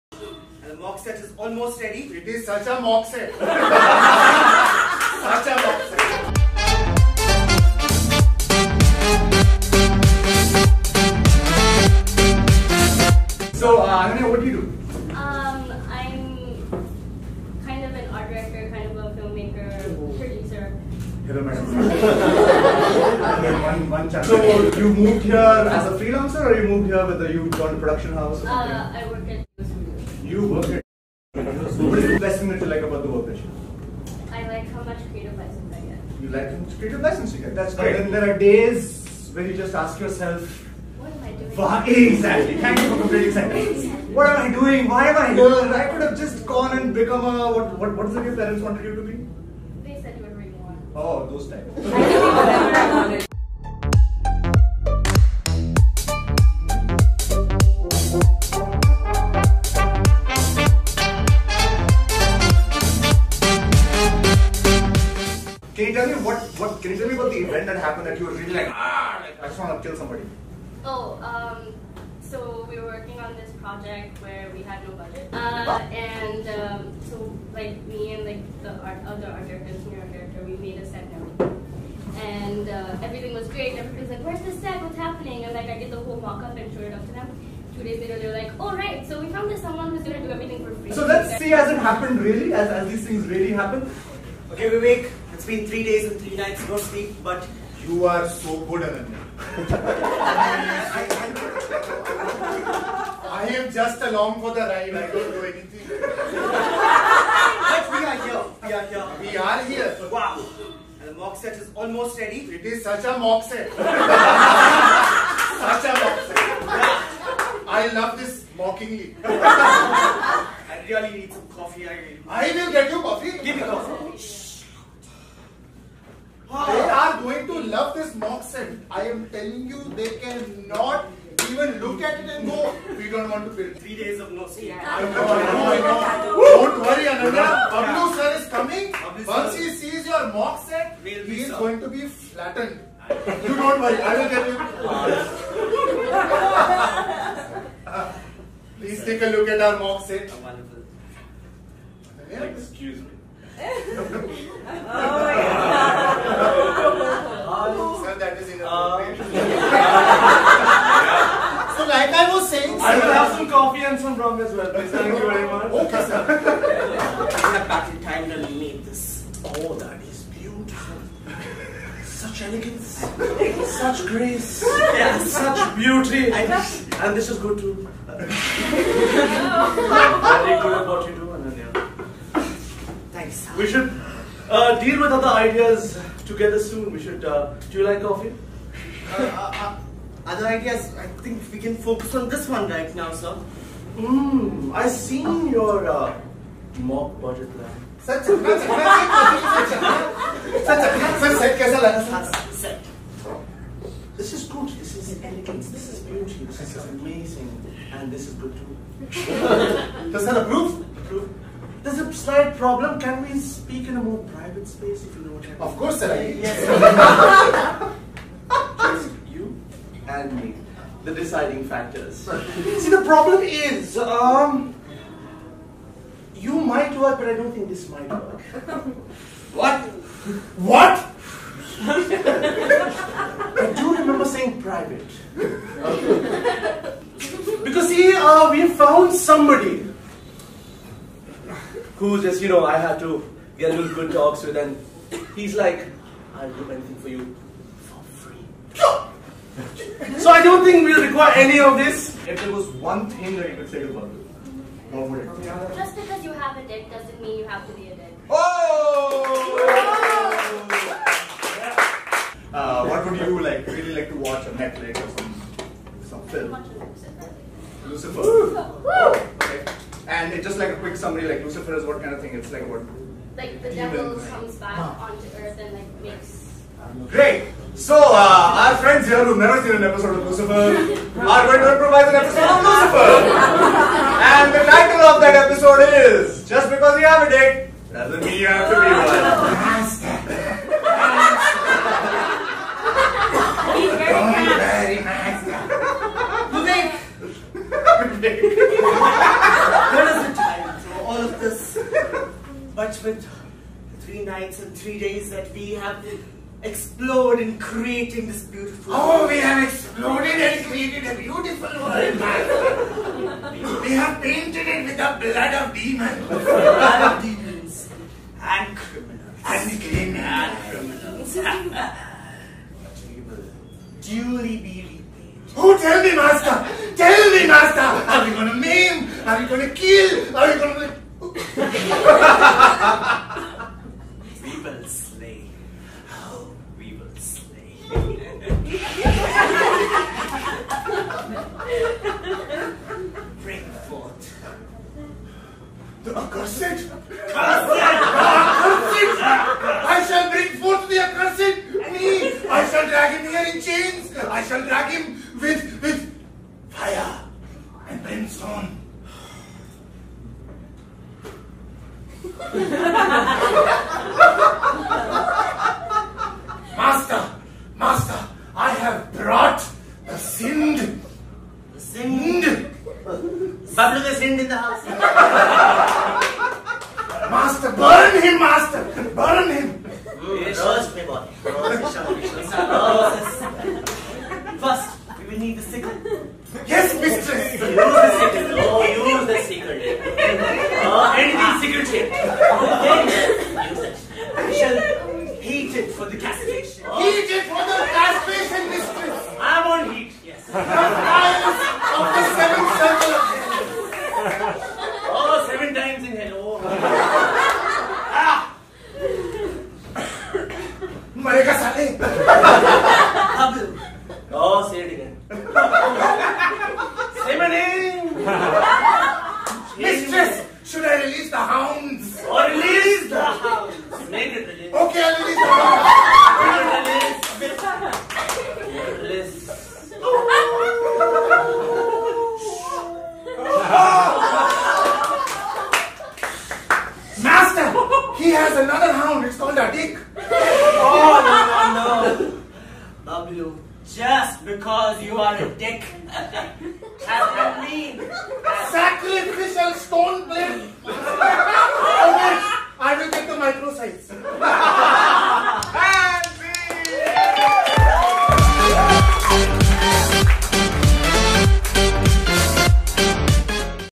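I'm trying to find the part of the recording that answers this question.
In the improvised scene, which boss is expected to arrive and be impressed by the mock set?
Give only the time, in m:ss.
2:17.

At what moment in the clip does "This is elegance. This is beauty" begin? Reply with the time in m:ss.
3:24.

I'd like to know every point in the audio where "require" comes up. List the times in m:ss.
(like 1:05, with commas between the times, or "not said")
4:11.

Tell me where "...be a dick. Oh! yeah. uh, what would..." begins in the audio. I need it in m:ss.
4:17.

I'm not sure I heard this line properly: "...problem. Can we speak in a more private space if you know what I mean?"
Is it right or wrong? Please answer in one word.
right.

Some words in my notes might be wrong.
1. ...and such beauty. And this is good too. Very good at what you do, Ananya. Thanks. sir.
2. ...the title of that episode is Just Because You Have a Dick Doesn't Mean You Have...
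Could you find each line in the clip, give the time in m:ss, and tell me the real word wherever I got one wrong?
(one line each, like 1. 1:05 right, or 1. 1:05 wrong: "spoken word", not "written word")
1. 2:54 right
2. 4:44 right.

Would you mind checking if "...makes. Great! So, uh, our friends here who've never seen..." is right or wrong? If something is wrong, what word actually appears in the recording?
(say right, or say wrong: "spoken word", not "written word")
right.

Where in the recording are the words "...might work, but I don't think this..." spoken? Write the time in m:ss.
3:46.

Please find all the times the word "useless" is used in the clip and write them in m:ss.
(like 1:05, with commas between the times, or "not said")
not said.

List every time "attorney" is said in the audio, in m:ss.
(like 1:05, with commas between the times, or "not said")
not said.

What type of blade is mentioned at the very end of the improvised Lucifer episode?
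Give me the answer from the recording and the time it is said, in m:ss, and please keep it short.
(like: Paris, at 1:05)
sacrificial stone blade, at 7:28.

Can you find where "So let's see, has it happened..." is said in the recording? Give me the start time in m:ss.
1:30.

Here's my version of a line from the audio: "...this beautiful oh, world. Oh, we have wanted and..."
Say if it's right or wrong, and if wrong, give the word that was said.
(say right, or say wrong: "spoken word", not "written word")
wrong: "exploded", not "wanted".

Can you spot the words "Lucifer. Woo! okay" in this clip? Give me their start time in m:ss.
4:27.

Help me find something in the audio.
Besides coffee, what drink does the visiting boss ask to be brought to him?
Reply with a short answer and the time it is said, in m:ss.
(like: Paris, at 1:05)
rum, at 2:44.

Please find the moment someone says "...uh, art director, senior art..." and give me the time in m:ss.
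1:19.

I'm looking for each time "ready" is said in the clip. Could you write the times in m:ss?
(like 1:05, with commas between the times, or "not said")
0:01, 1:52.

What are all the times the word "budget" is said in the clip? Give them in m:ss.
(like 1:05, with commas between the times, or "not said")
1:14, 3:17.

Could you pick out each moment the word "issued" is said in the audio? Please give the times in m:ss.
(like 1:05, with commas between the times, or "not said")
not said.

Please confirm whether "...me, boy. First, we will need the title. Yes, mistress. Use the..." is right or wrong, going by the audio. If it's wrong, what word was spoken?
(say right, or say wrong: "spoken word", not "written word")
wrong: "sickle", not "title".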